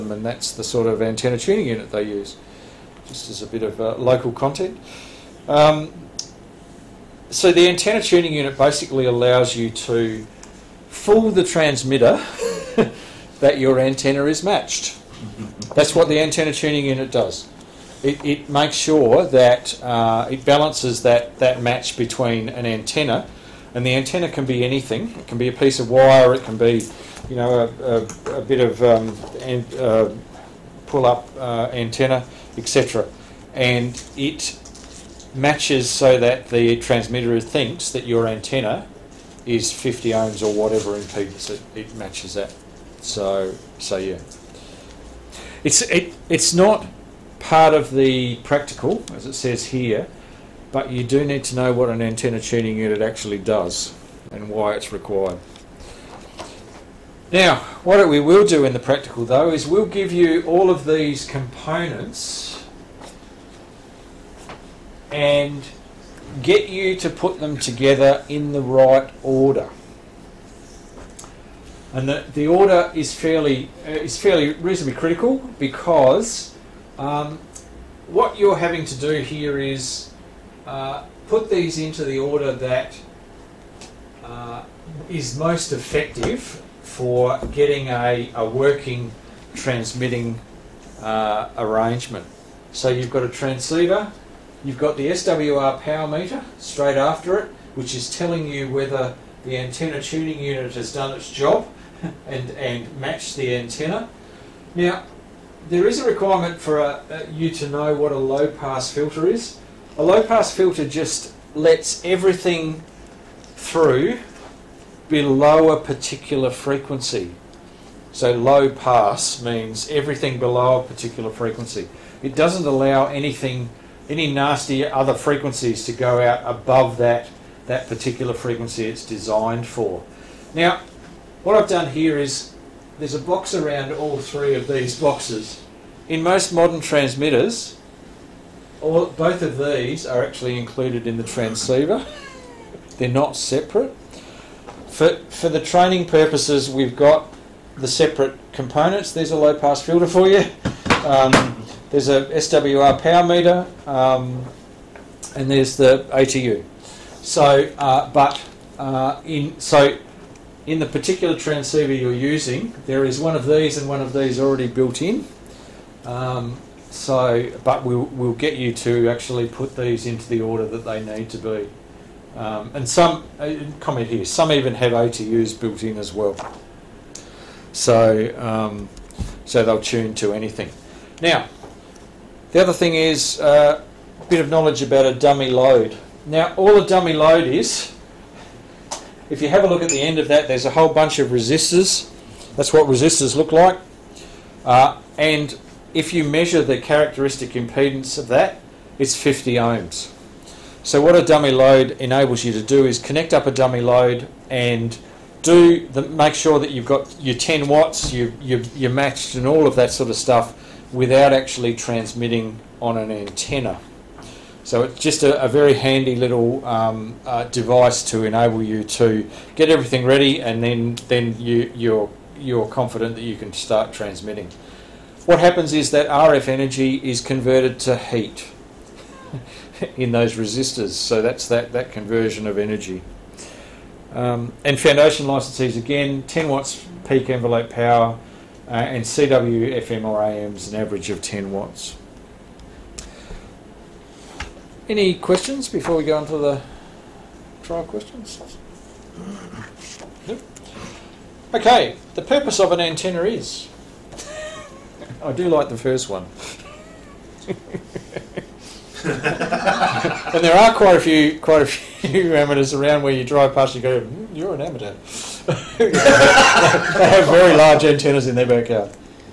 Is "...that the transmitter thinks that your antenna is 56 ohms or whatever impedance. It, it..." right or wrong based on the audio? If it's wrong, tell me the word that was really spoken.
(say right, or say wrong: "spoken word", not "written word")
wrong: "50", not "56".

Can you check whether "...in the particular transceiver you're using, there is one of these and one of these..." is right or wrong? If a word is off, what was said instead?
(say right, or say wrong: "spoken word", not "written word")
right.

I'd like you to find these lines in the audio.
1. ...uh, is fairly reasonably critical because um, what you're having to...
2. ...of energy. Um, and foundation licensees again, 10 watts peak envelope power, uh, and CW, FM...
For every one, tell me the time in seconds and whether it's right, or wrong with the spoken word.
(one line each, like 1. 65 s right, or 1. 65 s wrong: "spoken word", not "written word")
1. 73 s right
2. 232 s right.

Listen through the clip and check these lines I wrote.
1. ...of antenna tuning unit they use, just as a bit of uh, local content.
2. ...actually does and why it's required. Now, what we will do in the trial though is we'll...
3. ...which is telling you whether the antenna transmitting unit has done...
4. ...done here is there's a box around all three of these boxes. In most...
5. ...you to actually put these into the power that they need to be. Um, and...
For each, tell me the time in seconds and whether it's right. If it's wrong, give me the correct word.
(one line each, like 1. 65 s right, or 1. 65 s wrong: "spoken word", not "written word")
1. 0 s right
2. 53 s wrong: "practical", not "trial"
3. 97 s wrong: "tuning", not "transmitting"
4. 131 s right
5. 168 s wrong: "order", not "power".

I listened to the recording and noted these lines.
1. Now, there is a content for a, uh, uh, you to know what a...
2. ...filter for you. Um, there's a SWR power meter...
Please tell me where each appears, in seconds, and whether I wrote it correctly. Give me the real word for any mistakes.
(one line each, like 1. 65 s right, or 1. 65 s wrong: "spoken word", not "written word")
1. 104 s wrong: "requirement", not "content"
2. 149 s right.